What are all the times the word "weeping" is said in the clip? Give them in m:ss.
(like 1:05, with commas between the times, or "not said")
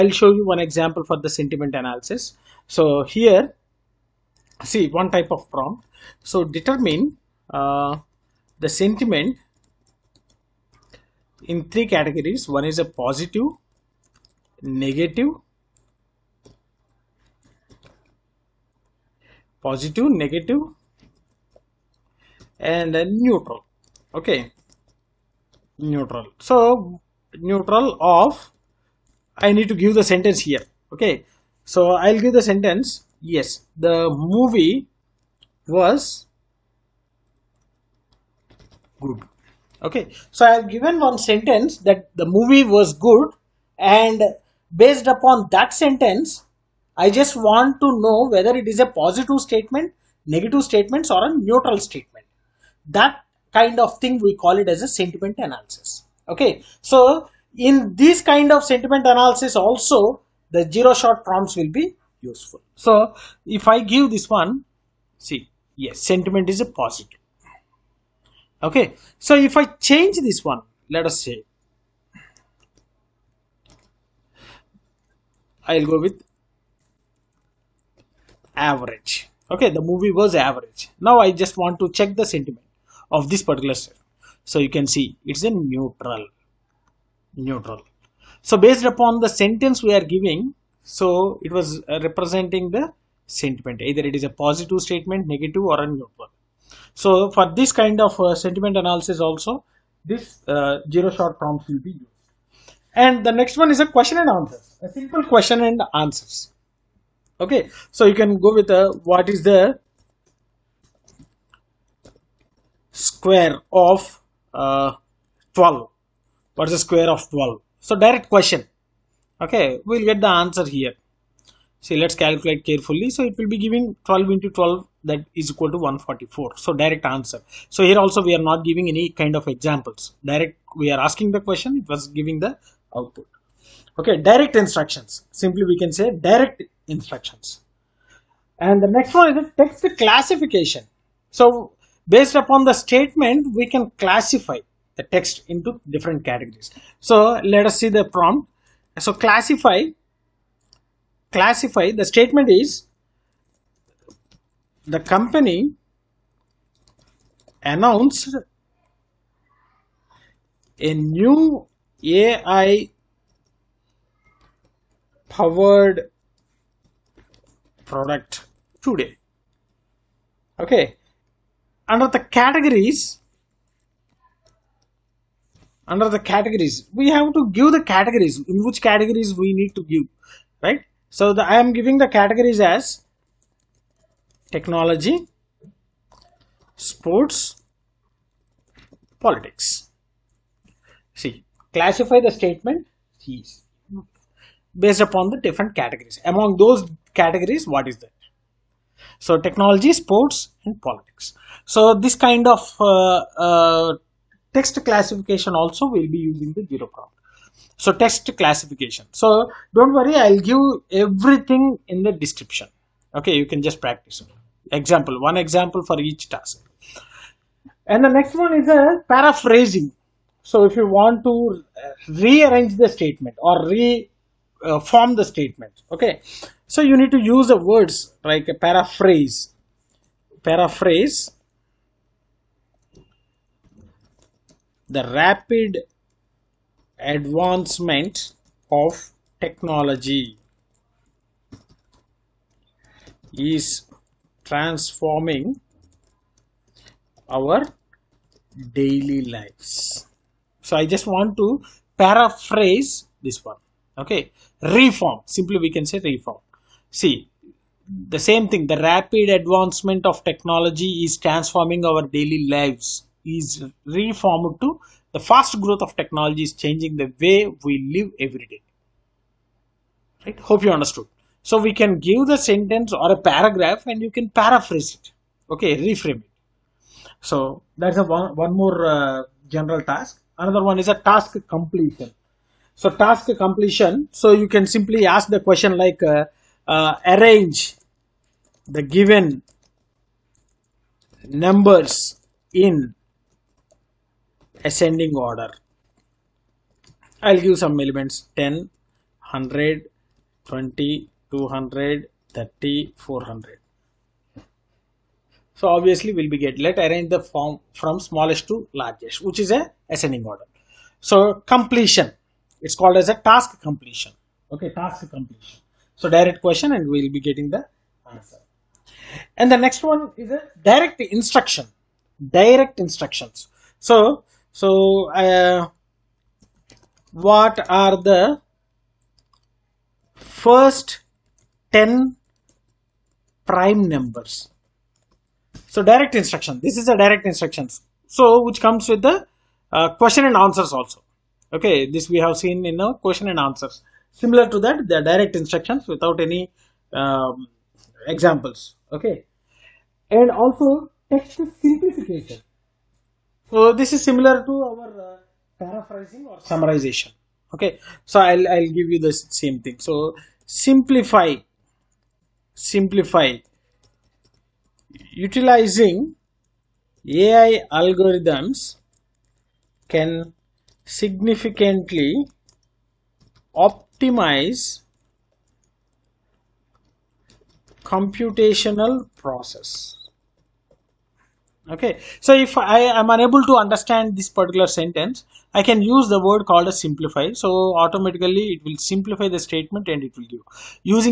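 not said.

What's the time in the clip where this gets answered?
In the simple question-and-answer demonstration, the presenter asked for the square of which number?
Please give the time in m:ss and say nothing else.
1:49.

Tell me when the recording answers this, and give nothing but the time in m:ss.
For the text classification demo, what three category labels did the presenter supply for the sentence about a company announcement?
3:04.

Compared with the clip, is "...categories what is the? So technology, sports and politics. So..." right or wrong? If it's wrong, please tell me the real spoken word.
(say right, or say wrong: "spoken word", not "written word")
right.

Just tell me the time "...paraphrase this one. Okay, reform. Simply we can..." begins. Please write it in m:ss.
4:11.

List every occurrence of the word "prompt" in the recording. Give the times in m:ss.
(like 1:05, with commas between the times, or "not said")
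0:05, 1:01, 1:41, 2:28, 3:26.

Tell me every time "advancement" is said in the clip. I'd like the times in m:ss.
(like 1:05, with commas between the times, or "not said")
3:56, 4:19.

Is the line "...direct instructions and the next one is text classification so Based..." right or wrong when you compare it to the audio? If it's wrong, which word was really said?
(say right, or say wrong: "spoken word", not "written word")
right.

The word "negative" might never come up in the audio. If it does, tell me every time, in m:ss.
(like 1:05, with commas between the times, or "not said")
0:14, 0:20, 0:50, 1:35.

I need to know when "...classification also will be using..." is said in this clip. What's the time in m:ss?
3:24.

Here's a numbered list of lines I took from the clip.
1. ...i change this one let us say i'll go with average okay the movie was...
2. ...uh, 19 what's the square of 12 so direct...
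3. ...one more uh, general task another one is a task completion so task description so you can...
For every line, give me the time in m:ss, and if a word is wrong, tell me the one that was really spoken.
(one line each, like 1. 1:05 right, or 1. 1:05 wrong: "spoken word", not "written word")
1. 1:09 right
2. 1:54 wrong: "12", not "19"
3. 4:38 wrong: "completion", not "description".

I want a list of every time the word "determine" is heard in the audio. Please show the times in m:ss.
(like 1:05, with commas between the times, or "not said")
0:06.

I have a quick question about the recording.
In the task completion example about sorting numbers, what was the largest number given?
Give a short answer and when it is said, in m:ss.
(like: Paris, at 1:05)
400, at 5:02.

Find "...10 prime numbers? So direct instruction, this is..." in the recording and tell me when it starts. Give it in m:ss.
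5:31.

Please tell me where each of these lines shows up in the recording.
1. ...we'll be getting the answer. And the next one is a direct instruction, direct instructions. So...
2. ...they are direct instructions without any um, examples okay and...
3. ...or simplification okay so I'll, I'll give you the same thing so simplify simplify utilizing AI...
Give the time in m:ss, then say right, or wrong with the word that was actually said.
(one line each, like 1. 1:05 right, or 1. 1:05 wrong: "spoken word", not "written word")
1. 5:16 right
2. 5:44 right
3. 5:56 wrong: "summarization", not "simplification".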